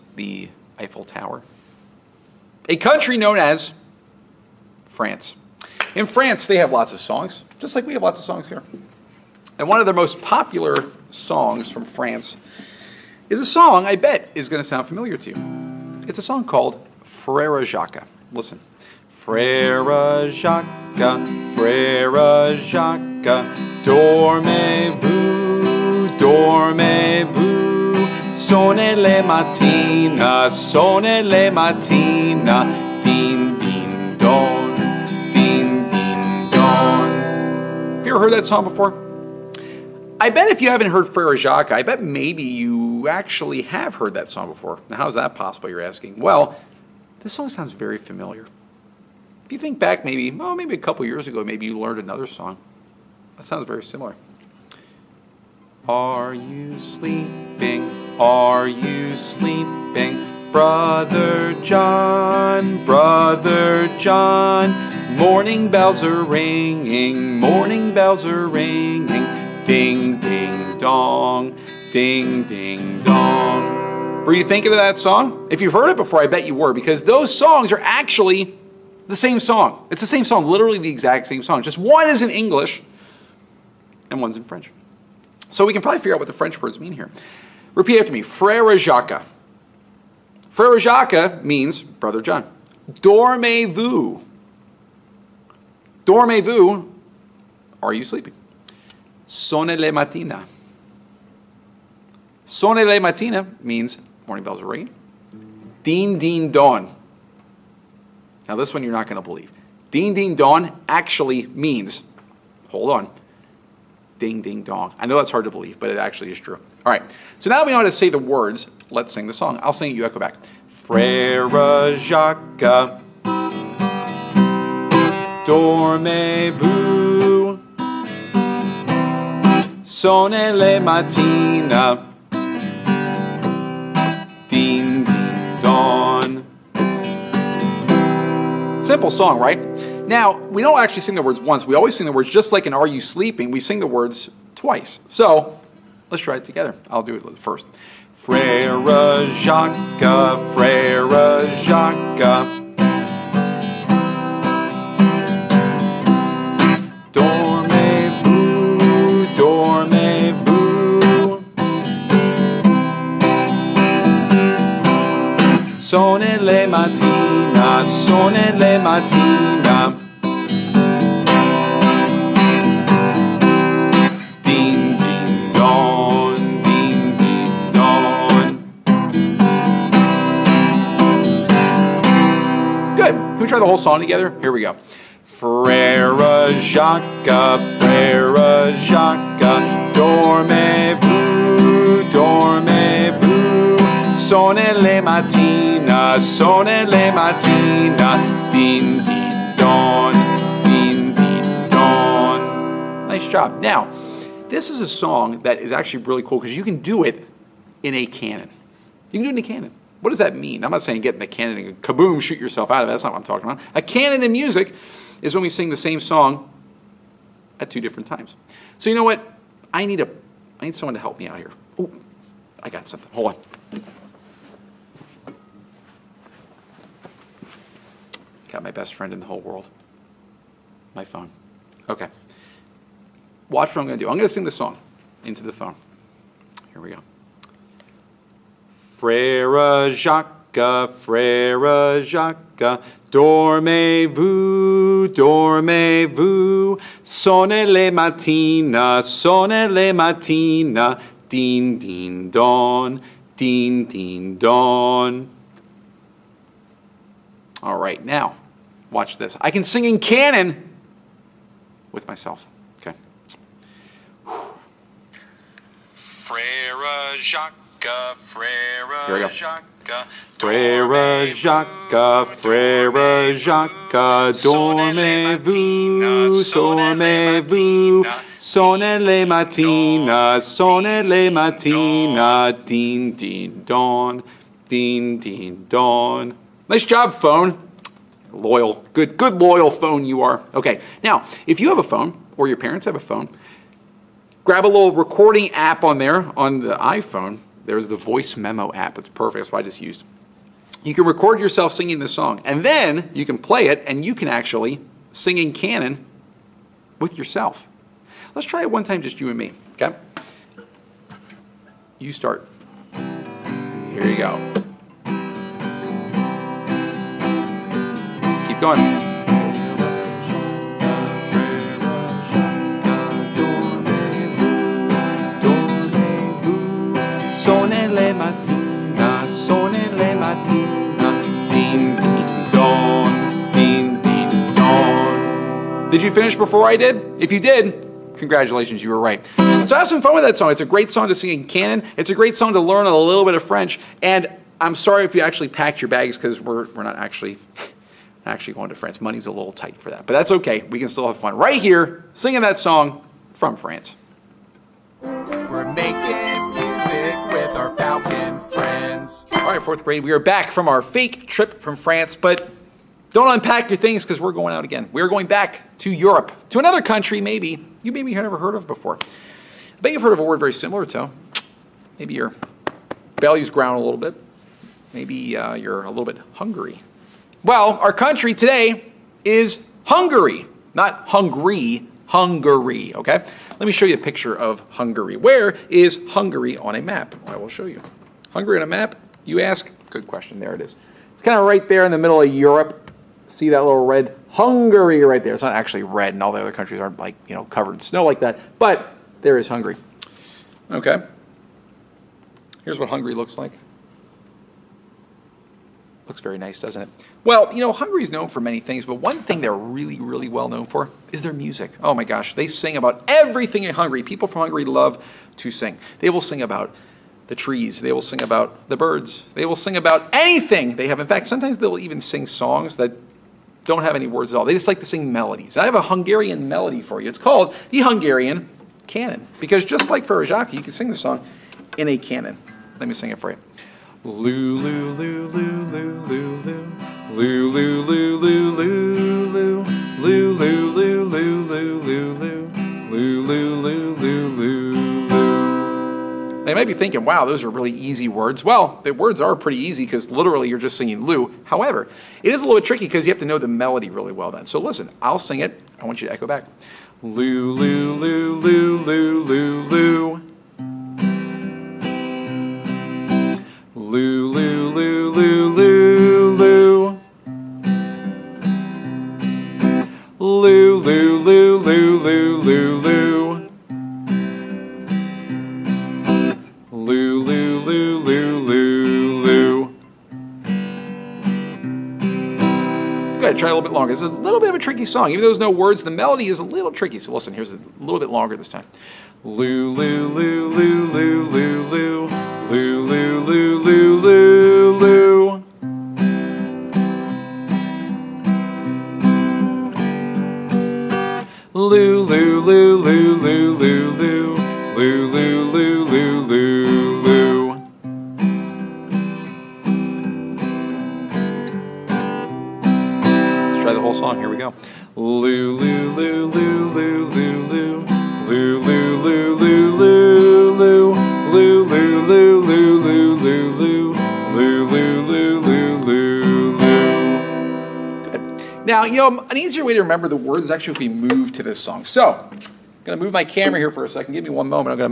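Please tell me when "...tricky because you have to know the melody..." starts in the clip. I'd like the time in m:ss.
7:32.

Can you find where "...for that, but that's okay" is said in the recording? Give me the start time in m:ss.
5:49.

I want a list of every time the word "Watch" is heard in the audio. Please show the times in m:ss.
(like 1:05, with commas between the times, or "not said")
3:53, 4:18.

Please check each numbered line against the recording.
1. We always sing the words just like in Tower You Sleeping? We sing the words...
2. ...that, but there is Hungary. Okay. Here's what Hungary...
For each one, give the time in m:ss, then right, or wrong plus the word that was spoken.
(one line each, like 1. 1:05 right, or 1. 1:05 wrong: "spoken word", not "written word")
1. 2:21 wrong: "Are", not "Tower"
2. 6:38 right.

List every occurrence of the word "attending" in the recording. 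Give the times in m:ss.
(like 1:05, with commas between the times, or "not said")
not said.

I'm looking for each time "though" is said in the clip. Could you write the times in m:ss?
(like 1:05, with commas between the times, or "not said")
8:05.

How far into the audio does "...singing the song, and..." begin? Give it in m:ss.
5:01.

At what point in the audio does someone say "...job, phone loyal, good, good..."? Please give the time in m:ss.
4:46.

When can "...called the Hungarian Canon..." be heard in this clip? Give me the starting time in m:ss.
7:07.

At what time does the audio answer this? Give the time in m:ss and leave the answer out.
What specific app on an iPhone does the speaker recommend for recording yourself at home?
4:57.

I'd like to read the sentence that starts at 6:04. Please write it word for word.
We're going back to Europe, to another country maybe you maybe have never heard of before.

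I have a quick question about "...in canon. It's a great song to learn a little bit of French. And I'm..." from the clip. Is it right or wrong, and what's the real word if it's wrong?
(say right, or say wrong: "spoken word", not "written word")
right.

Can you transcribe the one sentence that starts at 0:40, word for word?
I bet if you haven't heard Frere Jacques, I bet maybe you actually have heard that song before.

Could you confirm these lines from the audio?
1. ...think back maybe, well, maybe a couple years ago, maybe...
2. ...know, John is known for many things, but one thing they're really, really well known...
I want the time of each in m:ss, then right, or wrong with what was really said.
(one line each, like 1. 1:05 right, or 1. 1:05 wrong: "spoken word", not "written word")
1. 0:49 right
2. 6:47 wrong: "Hungary", not "John".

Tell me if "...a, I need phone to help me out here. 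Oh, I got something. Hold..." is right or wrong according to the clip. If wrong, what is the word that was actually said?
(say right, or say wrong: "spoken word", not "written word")
wrong: "someone", not "phone".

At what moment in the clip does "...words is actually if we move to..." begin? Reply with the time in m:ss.
8:50.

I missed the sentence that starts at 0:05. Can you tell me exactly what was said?
In France, they have lots of songs, just like we have lots of songs here.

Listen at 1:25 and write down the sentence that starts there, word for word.
So we can probably figure out what the French words mean here.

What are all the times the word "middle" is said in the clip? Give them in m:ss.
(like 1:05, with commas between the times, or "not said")
6:31.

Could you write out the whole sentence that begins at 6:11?
Maybe your belly's ground a little bit.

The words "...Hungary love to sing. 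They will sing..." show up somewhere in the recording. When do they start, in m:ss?
6:54.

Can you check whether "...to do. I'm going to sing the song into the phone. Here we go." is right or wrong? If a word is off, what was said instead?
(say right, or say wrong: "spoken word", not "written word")
right.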